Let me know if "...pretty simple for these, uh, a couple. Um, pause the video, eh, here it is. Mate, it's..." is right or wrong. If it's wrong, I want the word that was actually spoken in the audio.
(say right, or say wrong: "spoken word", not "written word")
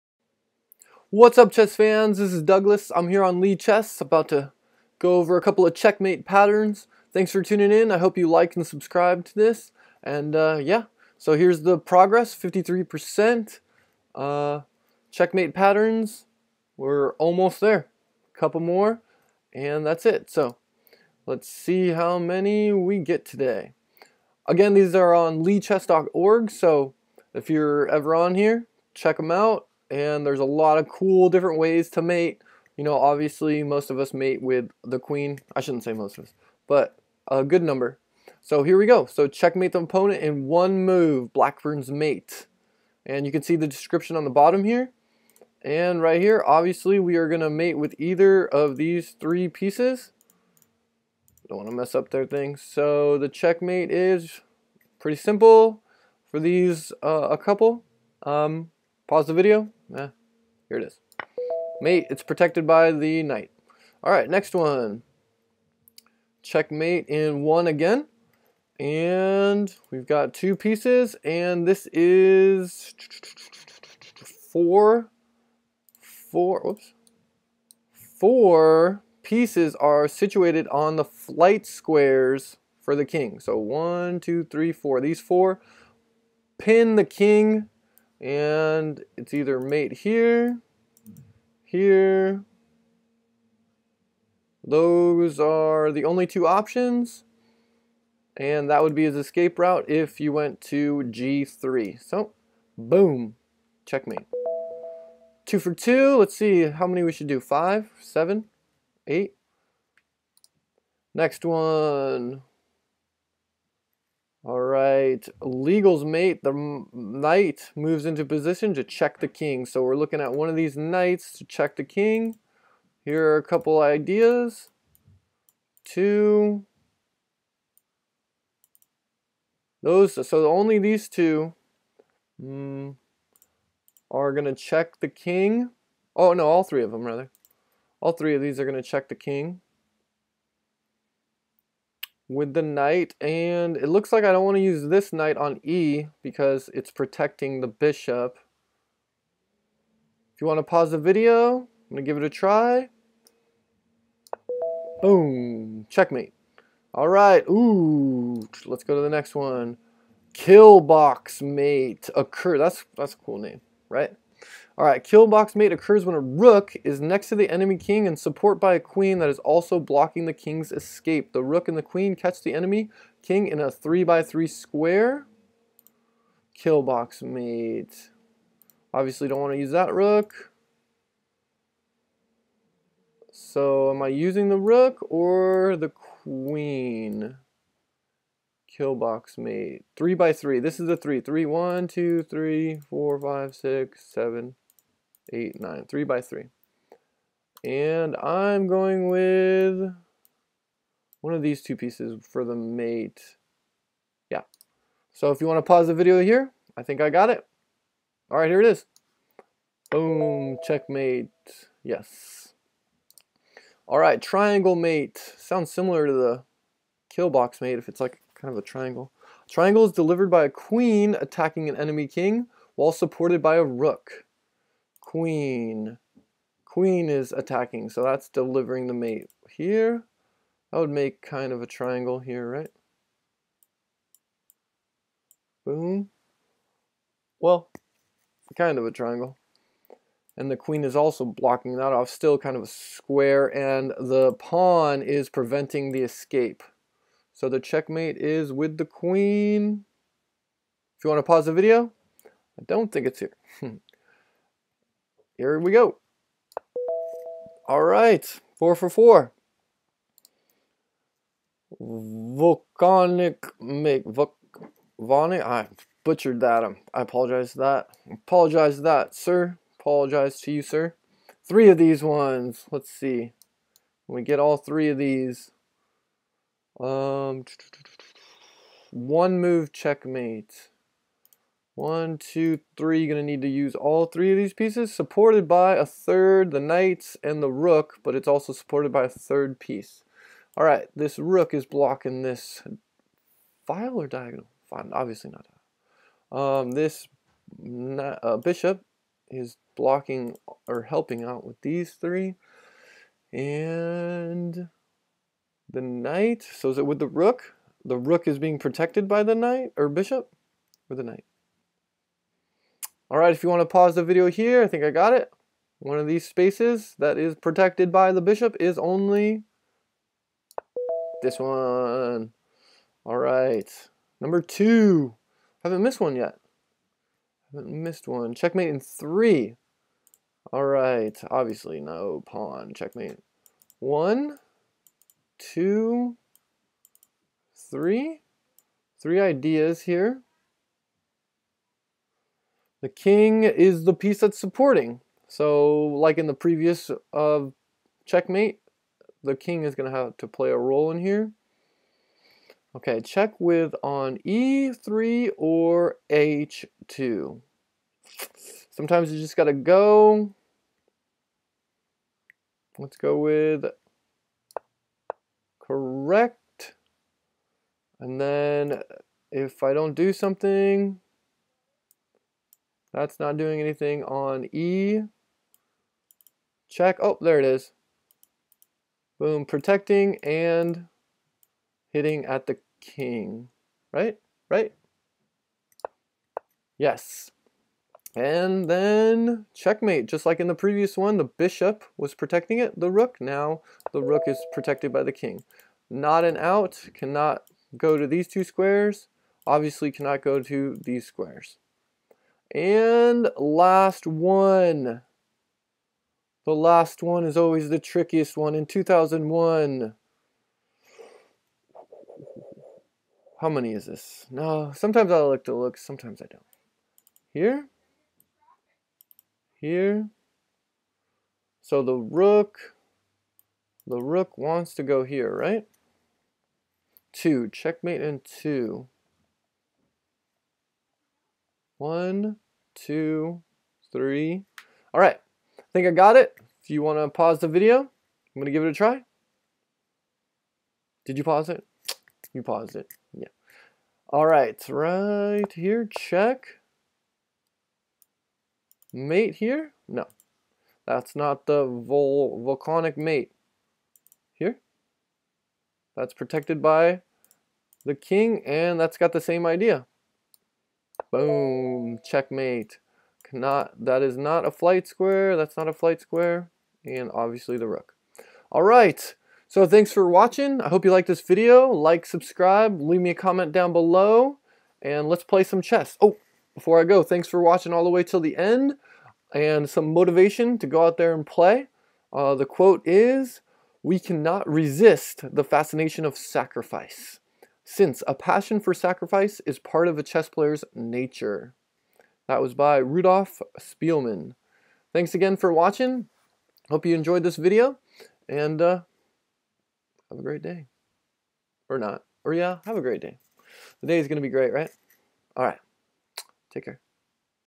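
right.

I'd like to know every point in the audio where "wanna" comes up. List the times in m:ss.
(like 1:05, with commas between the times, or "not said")
0:51, 7:16.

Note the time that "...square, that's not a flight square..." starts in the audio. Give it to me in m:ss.
7:44.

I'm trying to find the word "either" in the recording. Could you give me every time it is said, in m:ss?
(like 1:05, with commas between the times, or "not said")
0:47, 1:29.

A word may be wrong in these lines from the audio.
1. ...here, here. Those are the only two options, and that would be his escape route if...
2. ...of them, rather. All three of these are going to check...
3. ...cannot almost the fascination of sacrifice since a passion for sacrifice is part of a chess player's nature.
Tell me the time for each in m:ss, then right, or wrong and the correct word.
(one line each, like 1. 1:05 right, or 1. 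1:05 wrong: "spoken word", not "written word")
1. 1:29 right
2. 2:16 right
3. 8:03 wrong: "resist", not "almost".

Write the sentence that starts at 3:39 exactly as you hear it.
Triangle is delivered by a queen attacking an enemy king while supported by a rook queen.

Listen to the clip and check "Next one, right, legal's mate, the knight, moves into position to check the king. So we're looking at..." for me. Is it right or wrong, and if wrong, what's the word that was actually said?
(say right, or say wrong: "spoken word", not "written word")
right.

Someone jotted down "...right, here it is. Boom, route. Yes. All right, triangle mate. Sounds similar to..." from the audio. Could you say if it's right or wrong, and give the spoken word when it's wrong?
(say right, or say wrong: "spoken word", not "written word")
wrong: "checkmate", not "route".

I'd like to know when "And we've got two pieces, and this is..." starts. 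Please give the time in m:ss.
1:08.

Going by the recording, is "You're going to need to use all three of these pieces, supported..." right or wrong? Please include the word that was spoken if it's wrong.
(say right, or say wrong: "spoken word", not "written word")
right.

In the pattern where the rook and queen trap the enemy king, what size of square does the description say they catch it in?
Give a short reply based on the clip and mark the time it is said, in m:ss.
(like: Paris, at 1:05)
3 by 3, at 2:53.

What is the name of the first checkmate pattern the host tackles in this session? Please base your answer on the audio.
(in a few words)
Blackburne's mate.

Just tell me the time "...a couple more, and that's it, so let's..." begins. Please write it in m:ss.
0:18.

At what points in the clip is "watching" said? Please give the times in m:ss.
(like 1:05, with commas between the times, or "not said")
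7:50, 7:57, 8:15.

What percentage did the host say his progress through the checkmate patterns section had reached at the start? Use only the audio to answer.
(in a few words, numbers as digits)
53%.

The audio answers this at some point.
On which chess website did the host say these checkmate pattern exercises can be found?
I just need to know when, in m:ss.
0:25.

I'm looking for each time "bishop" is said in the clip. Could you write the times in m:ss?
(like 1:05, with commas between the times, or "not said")
2:27, 4:58, 5:09, 5:18, 6:31.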